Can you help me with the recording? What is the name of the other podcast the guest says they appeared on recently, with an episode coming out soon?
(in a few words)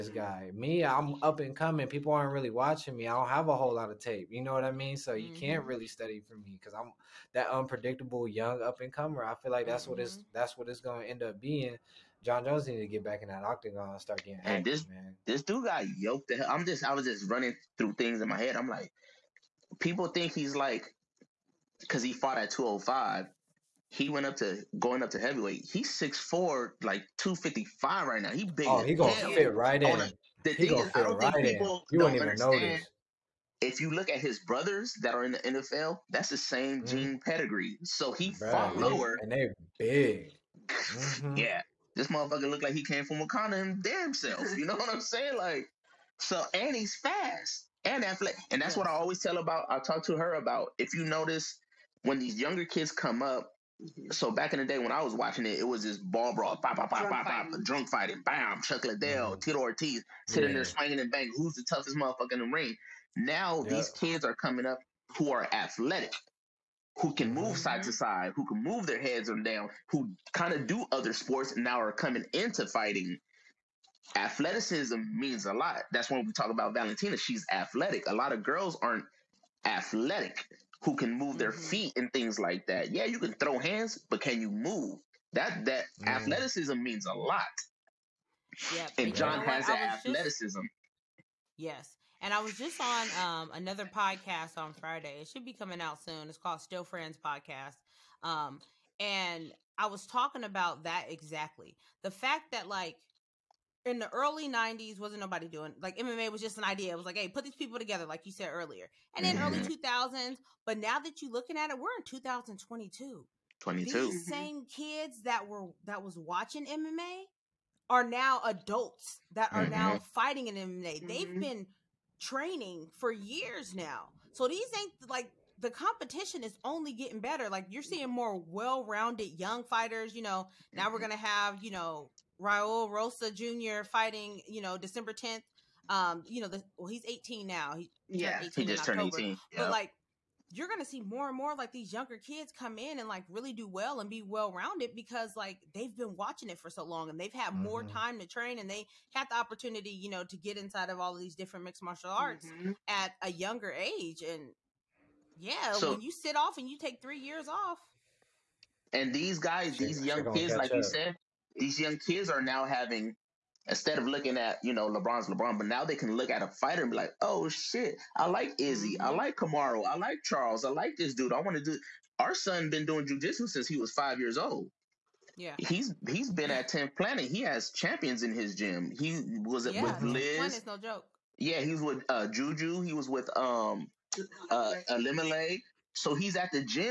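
Still Friends Podcast.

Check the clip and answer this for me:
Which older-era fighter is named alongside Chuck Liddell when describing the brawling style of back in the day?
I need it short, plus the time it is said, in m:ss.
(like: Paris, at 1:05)
Tito Ortiz, at 0:59.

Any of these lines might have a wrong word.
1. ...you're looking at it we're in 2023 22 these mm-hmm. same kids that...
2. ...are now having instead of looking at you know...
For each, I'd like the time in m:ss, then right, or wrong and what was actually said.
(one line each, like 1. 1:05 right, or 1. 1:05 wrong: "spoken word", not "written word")
1. 1:51 wrong: "2022", not "2023"
2. 2:42 right.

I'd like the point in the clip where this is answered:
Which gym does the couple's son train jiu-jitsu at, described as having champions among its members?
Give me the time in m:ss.
2:56.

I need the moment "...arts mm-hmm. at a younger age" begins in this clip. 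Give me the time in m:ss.
2:32.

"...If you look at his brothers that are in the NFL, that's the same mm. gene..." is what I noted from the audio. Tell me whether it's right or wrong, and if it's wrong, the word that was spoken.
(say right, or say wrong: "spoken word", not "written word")
right.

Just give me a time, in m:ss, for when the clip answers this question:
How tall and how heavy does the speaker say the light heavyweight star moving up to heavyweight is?
0:25.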